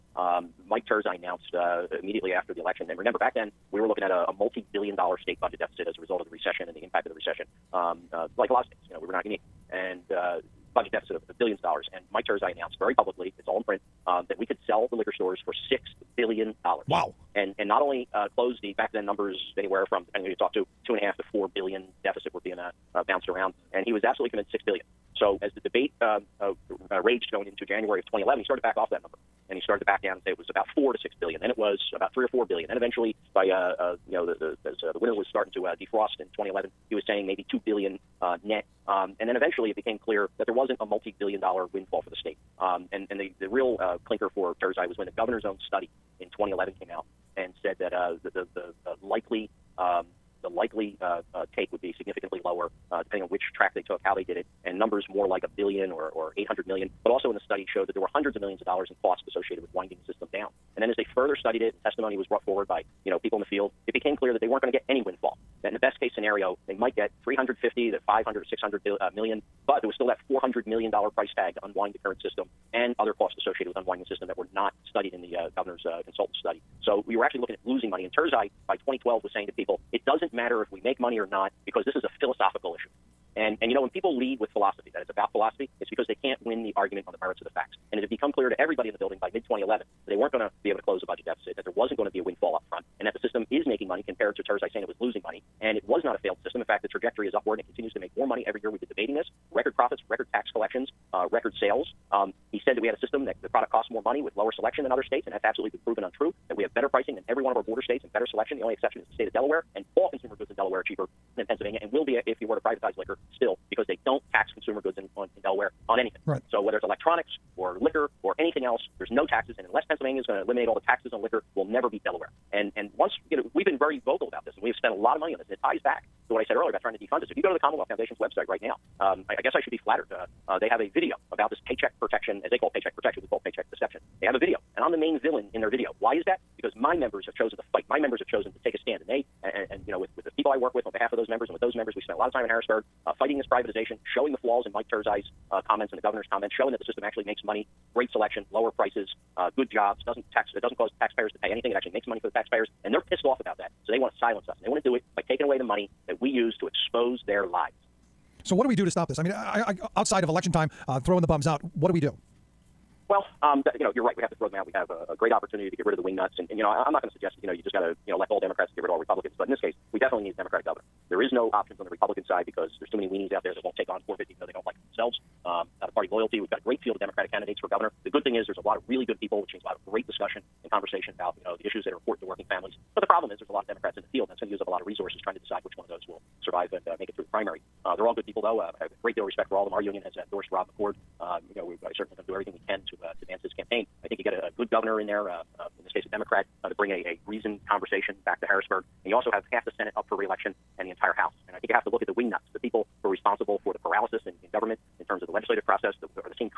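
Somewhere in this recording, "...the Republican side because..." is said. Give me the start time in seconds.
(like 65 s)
171 s.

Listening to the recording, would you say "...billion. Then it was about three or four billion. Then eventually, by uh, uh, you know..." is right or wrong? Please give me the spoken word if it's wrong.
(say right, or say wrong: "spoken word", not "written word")
right.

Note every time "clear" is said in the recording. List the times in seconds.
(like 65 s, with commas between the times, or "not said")
40 s, 64 s, 88 s.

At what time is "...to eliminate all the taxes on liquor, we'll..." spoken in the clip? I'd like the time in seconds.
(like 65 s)
120 s.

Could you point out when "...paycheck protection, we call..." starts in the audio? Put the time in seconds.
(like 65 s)
132 s.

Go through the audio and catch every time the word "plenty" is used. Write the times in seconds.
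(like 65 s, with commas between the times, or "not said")
not said.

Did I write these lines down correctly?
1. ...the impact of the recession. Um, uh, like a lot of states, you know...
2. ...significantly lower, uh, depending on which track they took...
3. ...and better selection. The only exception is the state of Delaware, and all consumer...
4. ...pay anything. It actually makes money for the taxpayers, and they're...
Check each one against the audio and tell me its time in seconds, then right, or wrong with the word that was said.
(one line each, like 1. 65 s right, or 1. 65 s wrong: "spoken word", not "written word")
1. 6 s right
2. 51 s right
3. 108 s right
4. 151 s right.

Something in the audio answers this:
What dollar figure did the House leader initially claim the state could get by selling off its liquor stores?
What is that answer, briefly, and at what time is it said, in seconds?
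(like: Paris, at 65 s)
$6 billion, at 15 s.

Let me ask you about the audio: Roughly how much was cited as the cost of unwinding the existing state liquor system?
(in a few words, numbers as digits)
$400 million.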